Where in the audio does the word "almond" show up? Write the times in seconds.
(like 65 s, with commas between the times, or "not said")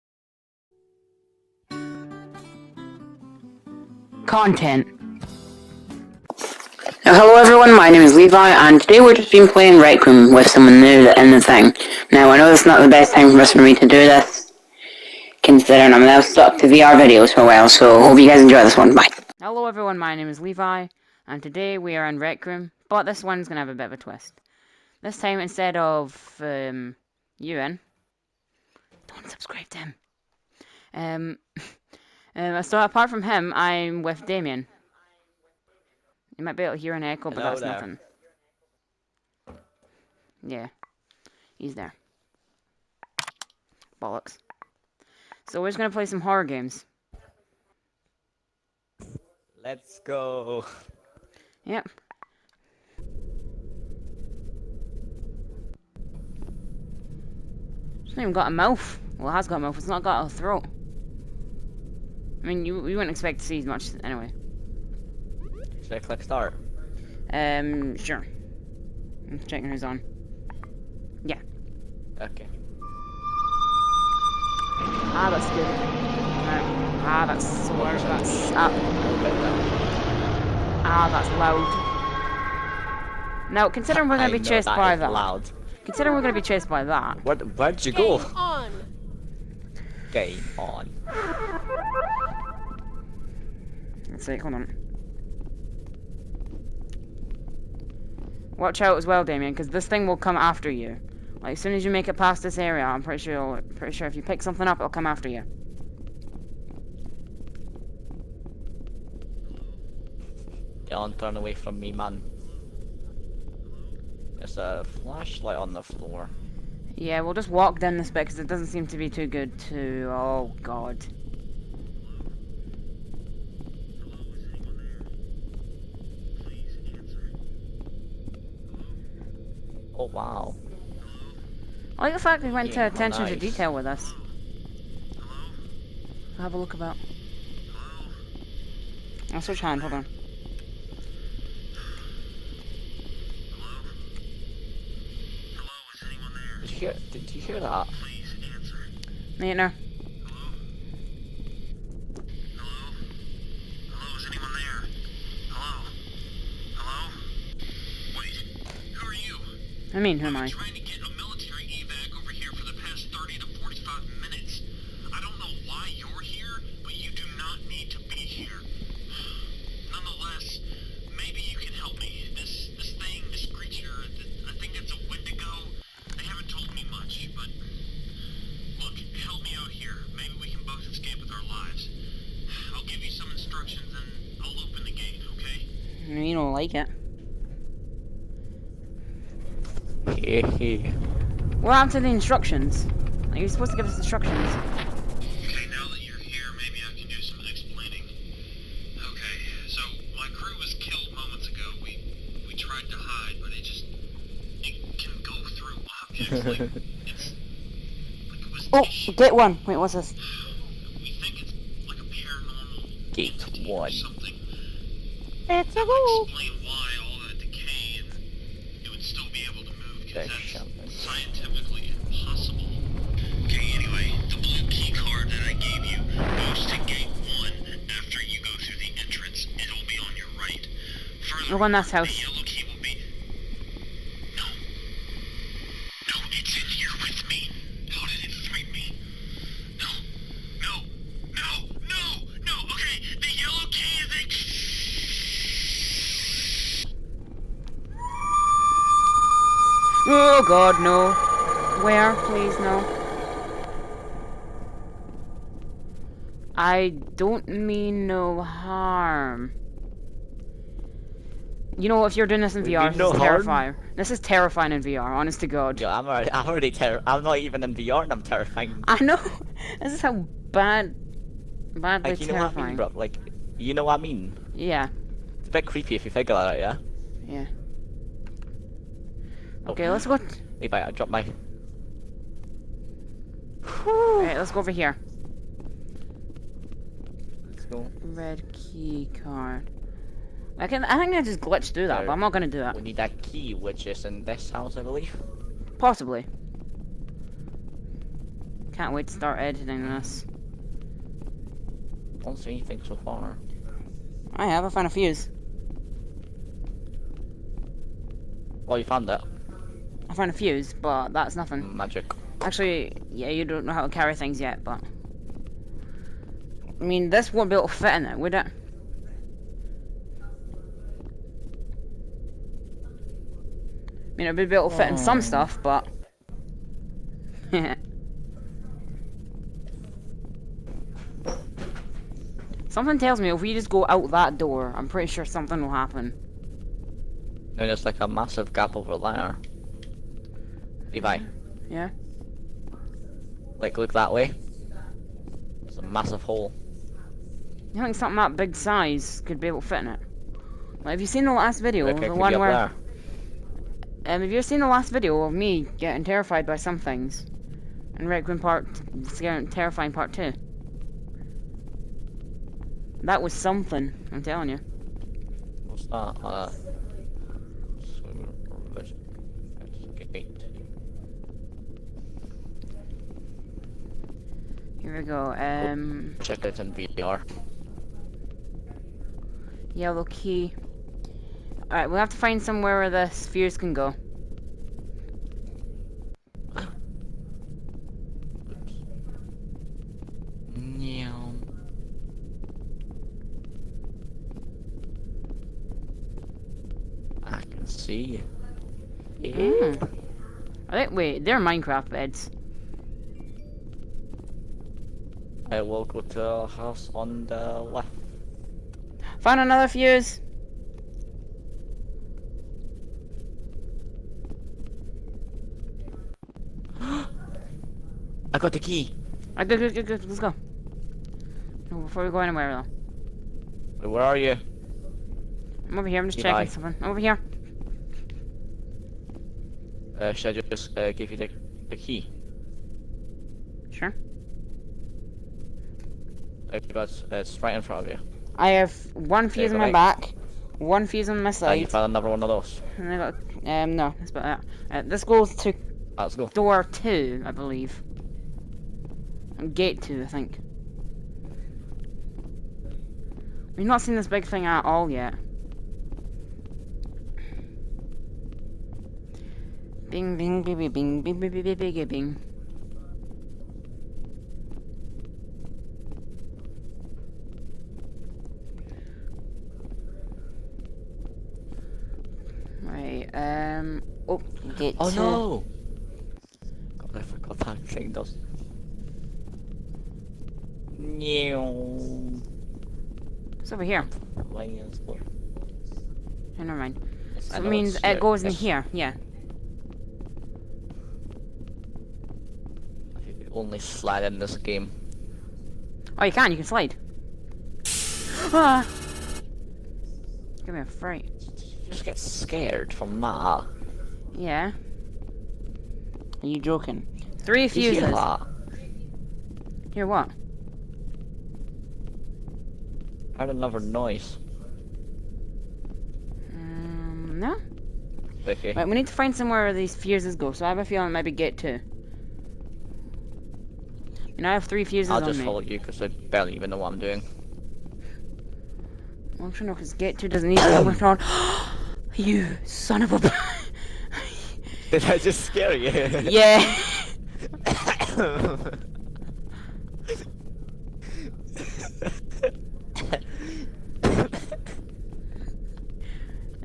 not said.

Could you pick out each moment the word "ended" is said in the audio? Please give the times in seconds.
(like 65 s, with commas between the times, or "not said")
not said.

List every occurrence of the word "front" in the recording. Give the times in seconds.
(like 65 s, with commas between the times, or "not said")
437 s.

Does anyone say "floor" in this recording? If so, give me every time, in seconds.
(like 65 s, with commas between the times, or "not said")
115 s, 484 s.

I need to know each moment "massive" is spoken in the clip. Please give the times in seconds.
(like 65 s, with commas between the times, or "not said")
338 s, 345 s.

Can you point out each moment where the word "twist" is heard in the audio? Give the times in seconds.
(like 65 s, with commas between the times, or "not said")
23 s.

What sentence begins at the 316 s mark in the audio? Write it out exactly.
I mean, this won't be able to fit in it, would it?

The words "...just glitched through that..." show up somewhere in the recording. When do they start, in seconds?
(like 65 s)
291 s.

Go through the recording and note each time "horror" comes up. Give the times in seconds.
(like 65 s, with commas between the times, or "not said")
46 s.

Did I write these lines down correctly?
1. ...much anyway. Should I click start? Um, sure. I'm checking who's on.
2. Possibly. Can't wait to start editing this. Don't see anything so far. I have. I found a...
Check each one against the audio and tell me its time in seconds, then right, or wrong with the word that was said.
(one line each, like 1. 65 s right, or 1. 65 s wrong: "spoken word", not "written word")
1. 63 s right
2. 295 s right.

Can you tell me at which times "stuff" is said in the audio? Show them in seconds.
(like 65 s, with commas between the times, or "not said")
325 s.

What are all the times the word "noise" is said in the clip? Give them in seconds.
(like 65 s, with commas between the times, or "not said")
513 s.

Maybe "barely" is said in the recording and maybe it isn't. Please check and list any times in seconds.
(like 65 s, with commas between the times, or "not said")
525 s.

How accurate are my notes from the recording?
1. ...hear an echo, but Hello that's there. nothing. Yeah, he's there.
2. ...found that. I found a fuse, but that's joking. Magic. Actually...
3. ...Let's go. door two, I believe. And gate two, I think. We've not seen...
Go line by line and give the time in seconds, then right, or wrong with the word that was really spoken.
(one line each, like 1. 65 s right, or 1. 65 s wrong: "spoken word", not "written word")
1. 36 s right
2. 308 s wrong: "nothing", not "joking"
3. 445 s right.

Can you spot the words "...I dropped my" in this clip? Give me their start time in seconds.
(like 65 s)
280 s.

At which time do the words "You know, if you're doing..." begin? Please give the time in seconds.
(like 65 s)
261 s.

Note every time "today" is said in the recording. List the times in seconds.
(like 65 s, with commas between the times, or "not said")
8 s, 21 s.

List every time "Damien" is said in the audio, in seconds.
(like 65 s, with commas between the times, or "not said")
34 s, 99 s.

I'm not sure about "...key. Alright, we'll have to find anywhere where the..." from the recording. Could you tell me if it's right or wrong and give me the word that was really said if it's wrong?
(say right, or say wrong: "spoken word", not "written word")
wrong: "somewhere", not "anywhere".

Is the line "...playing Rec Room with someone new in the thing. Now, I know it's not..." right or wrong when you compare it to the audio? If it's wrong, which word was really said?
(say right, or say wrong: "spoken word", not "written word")
right.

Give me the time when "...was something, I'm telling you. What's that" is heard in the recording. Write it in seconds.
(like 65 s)
363 s.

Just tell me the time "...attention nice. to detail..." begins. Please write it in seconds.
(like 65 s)
132 s.